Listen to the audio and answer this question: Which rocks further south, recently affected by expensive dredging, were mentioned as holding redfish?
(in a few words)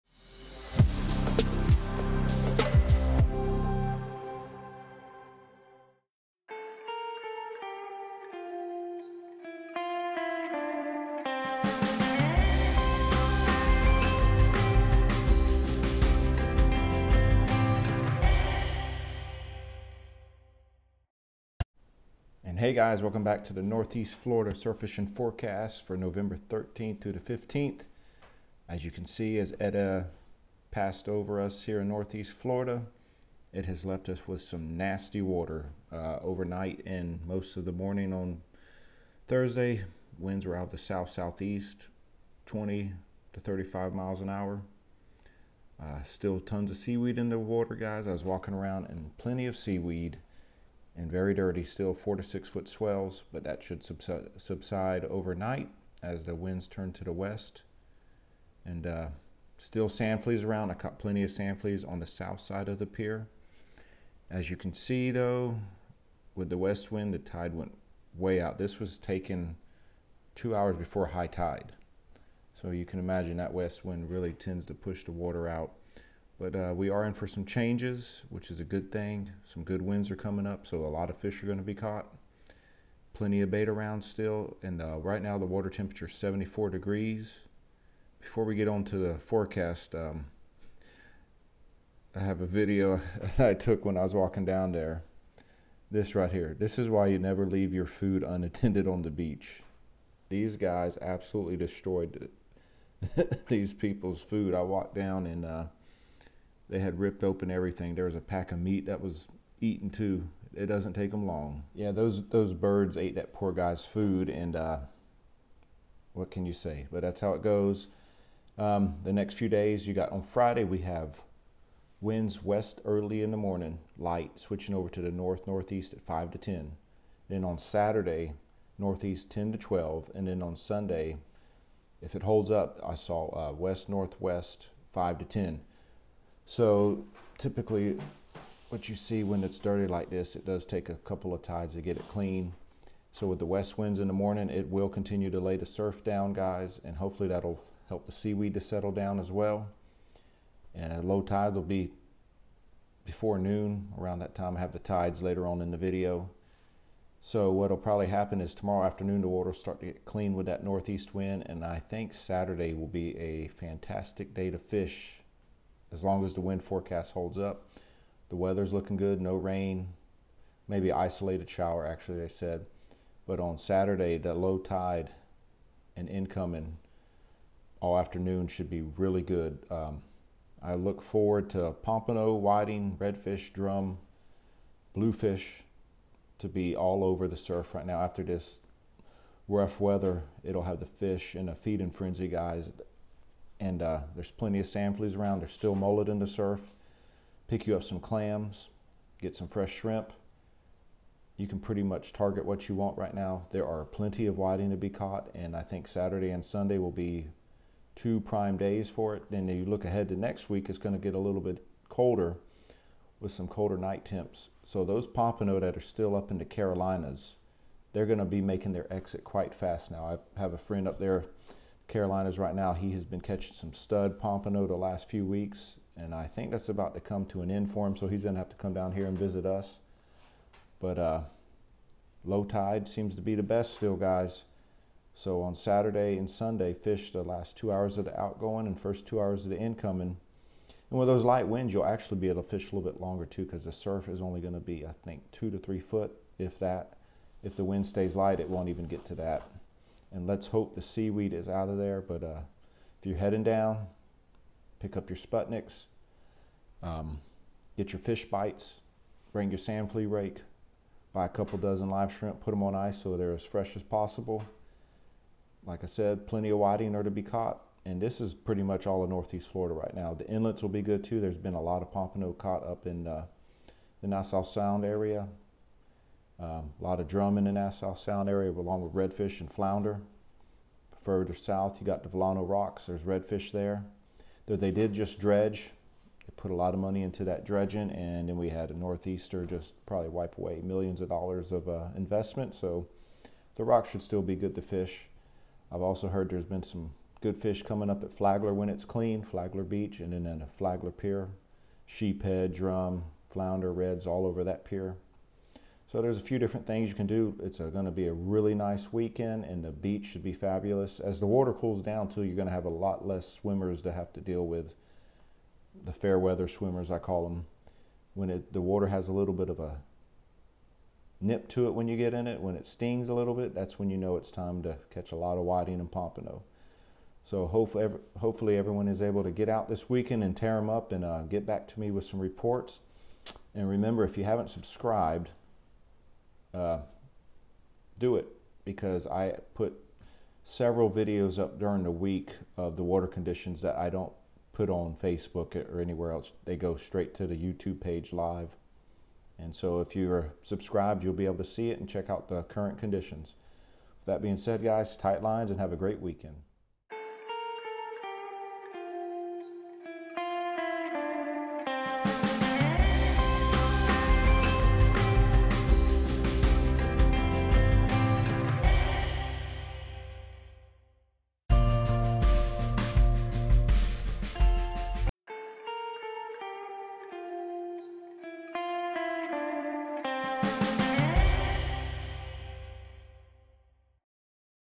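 Vilano Rocks.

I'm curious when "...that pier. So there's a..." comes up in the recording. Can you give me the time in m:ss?
5:04.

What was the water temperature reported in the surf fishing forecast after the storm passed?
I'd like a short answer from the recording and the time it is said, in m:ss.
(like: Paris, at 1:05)
74 degrees, at 1:26.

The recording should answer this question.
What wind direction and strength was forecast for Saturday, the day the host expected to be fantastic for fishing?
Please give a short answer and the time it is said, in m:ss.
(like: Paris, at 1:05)
Northeast 10 to 12, at 2:08.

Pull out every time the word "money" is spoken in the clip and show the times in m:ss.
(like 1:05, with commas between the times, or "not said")
4:46.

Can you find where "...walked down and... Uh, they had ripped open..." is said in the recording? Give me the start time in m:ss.
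1:44.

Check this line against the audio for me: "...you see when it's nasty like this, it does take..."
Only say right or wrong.
wrong.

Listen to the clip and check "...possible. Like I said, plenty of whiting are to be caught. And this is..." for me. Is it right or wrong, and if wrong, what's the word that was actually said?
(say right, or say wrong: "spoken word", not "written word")
right.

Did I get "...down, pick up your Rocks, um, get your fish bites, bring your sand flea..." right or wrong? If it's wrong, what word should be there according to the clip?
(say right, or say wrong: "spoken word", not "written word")
wrong: "Sputniks", not "Rocks".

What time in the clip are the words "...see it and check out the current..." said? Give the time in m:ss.
5:51.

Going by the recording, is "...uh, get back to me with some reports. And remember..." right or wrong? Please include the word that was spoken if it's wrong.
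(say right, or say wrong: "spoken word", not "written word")
right.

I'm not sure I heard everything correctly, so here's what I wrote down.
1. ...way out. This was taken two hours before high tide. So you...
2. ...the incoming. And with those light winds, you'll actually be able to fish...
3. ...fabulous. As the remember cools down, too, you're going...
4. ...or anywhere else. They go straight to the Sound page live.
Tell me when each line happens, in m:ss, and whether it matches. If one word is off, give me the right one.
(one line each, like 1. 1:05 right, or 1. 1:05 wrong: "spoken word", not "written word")
1. 1:08 right
2. 3:59 right
3. 5:10 wrong: "water", not "remember"
4. 5:45 wrong: "YouTube", not "Sound".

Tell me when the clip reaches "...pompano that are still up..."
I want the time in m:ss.
3:35.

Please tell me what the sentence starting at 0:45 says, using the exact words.
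Uh, still tons of seaweed in the water, guys.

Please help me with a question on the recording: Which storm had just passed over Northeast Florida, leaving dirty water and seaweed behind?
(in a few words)
Eta.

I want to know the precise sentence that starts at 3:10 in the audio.
It'll have the fish and the feed and frenzy guys and uh, there's plenty of sand fleas around.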